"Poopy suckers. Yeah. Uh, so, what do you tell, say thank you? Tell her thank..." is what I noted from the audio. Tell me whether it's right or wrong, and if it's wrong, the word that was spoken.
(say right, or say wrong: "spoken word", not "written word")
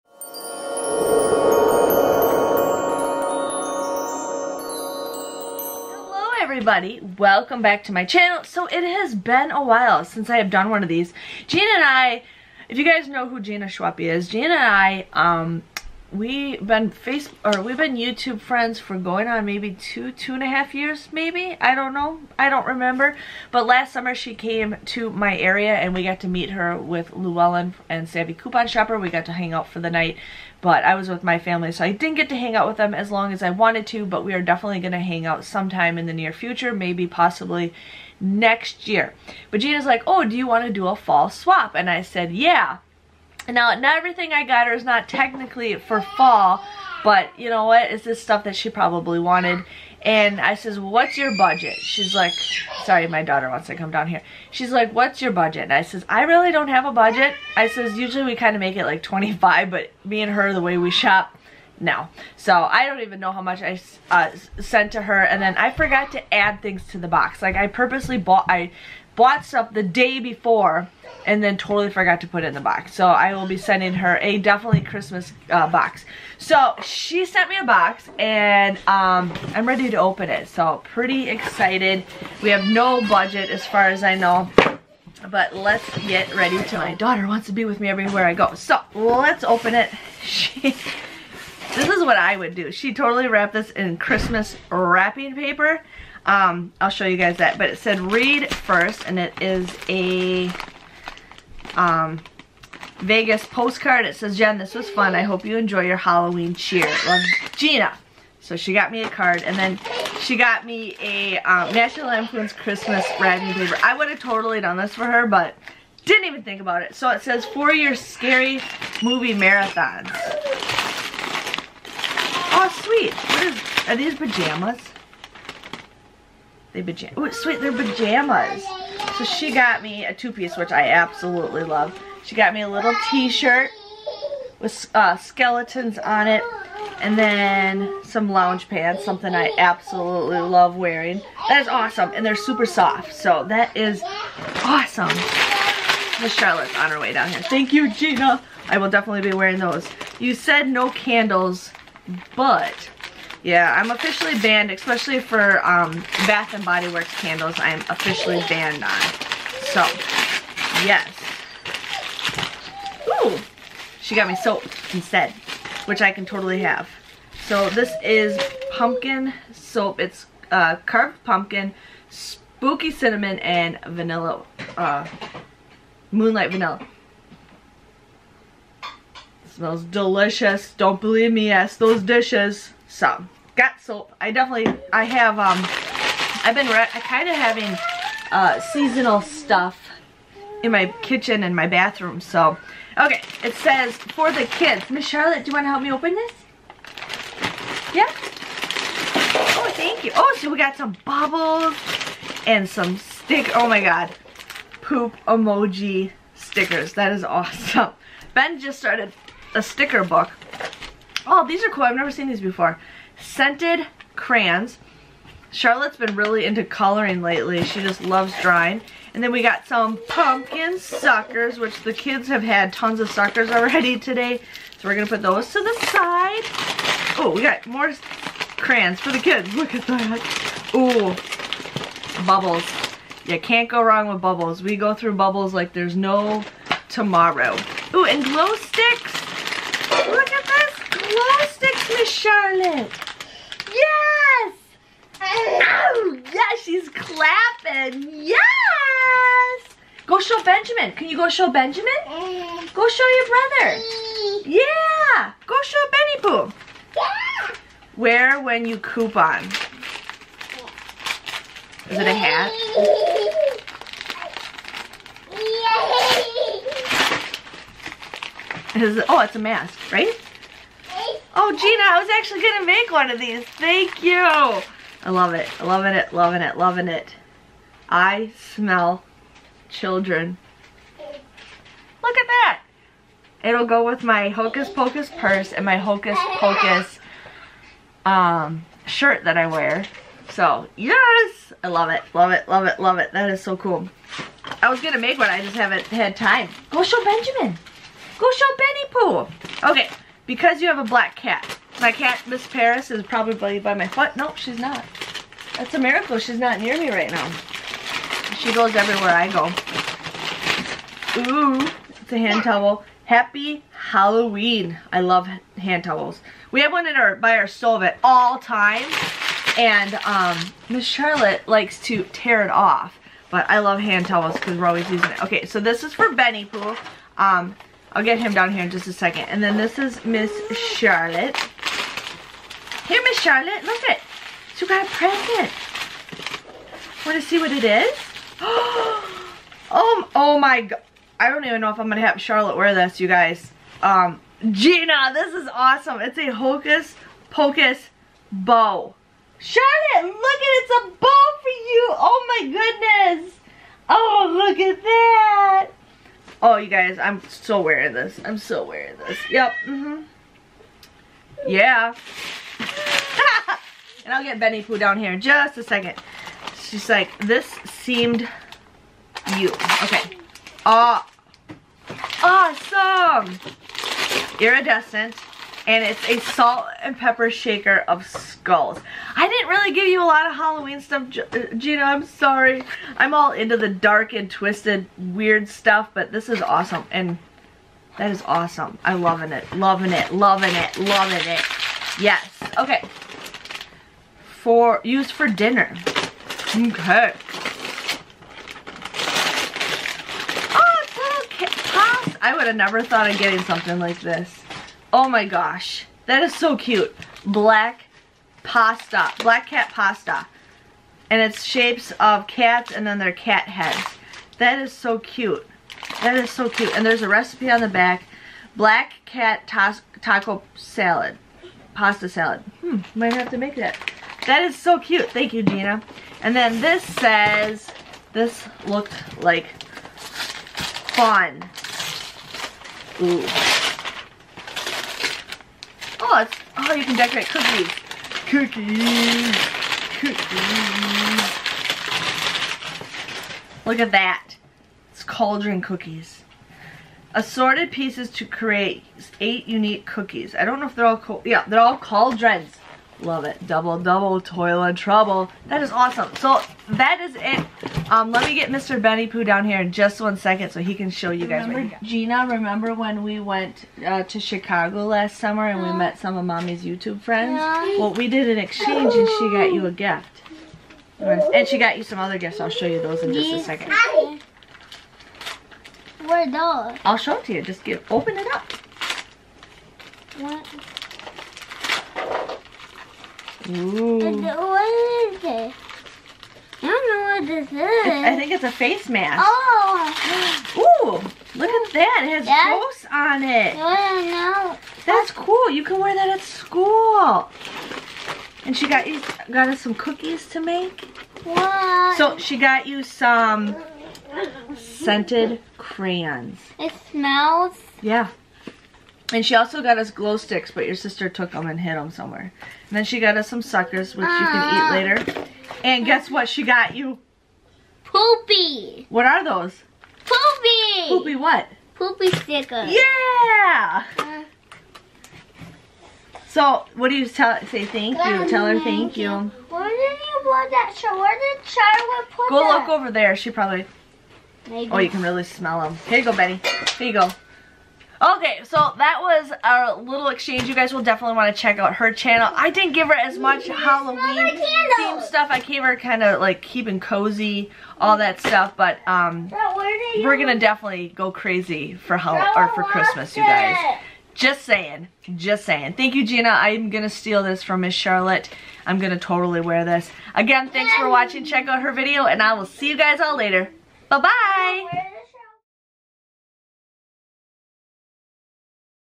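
wrong: "stickers", not "suckers".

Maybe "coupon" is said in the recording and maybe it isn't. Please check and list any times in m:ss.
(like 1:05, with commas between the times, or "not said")
0:28, 4:18.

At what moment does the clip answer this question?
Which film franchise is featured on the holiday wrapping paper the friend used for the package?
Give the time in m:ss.
1:51.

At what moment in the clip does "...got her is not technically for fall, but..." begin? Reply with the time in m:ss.
0:44.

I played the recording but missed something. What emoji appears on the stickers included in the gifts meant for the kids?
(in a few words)
Poop emoji.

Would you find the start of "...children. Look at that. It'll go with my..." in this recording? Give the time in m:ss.
4:39.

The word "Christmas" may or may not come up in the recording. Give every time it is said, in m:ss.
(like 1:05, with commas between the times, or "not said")
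1:14, 1:33, 1:52, 9:12.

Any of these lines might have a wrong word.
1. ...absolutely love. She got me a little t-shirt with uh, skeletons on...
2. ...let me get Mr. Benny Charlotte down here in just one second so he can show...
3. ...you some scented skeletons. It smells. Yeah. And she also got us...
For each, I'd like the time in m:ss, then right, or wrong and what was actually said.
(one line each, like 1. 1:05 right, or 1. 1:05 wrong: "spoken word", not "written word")
1. 2:10 right
2. 7:38 wrong: "Poo", not "Charlotte"
3. 8:22 wrong: "crayons", not "skeletons".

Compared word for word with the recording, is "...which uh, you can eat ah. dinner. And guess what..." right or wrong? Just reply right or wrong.
wrong.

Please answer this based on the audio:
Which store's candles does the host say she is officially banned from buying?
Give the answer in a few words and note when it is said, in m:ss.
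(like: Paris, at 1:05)
Bath and Body Works, at 2:36.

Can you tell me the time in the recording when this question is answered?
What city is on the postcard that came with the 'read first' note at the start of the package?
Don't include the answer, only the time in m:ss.
1:42.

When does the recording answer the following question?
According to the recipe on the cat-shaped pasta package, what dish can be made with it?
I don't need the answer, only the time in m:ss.
6:58.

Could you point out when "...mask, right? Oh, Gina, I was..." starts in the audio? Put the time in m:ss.
4:29.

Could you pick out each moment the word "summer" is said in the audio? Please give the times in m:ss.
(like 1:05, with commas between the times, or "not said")
0:23, 7:45.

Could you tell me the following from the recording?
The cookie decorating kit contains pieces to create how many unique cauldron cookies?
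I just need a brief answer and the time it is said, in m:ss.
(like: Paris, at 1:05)
8, at 7:29.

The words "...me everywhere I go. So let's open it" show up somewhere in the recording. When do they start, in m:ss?
1:27.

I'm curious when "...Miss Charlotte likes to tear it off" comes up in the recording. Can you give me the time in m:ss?
5:20.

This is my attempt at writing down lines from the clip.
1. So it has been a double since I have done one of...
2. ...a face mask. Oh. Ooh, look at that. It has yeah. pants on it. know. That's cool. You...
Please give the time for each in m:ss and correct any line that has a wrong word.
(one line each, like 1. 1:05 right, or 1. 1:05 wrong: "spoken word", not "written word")
1. 0:08 wrong: "while", not "double"
2. 8:08 wrong: "ghosts", not "pants".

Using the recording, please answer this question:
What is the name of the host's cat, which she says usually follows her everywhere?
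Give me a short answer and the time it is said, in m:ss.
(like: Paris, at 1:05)
Miss Paris, at 5:02.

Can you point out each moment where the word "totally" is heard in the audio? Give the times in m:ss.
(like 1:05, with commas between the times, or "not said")
1:11, 1:32, 1:54, 2:46, 9:18.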